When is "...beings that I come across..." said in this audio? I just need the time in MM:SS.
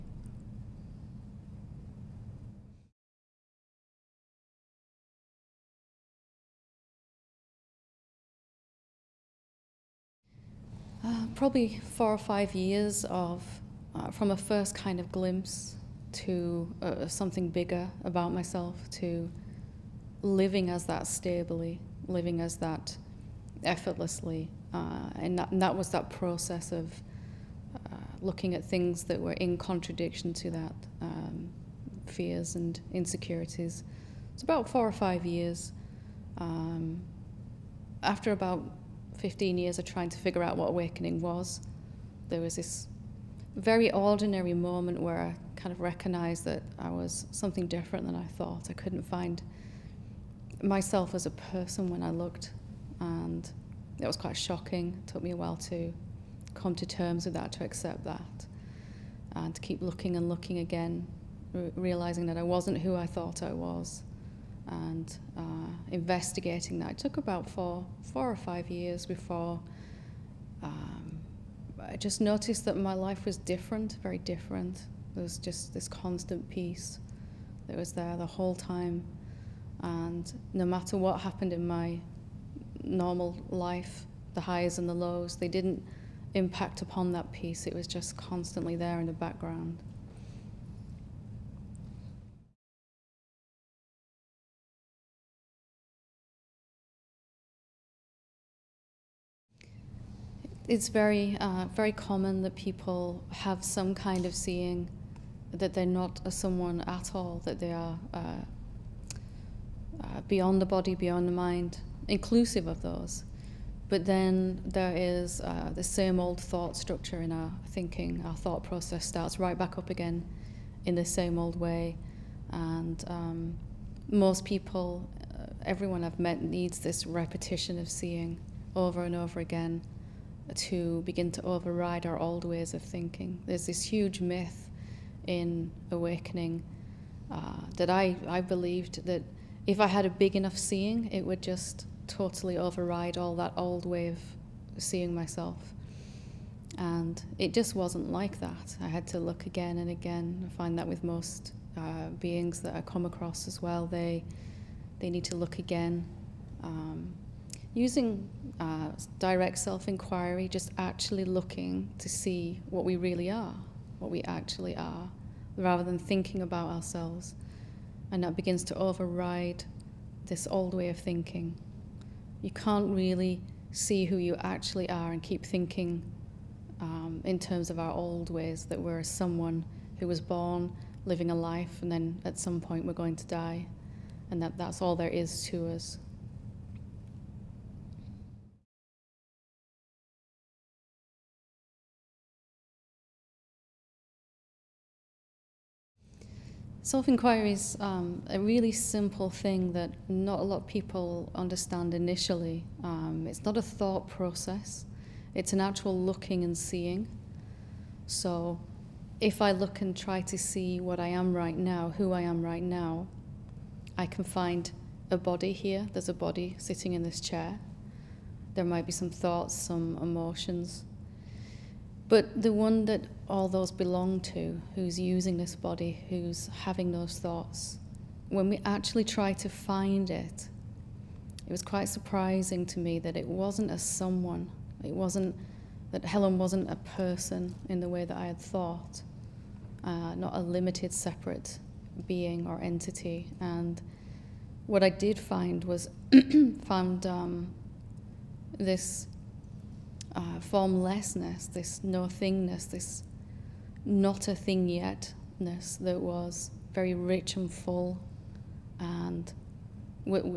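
02:32.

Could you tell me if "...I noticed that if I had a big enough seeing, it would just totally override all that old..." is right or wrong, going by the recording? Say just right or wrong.
wrong.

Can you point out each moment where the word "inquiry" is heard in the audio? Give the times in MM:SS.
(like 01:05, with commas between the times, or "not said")
02:39, 03:16.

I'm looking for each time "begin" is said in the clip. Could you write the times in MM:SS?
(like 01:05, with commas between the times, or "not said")
02:11, 02:48.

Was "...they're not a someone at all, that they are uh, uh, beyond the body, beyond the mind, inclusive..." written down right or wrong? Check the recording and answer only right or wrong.
right.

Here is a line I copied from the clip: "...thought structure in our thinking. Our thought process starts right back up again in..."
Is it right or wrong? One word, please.
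right.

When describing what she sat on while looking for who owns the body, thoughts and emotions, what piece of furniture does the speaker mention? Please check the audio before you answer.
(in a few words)
chair.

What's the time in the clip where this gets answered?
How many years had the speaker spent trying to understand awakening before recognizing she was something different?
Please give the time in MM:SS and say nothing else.
00:39.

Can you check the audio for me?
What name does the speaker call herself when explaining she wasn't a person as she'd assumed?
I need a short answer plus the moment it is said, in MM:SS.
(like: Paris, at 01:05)
Helen, at 03:56.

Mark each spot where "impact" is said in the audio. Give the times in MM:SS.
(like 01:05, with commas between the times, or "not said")
01:26.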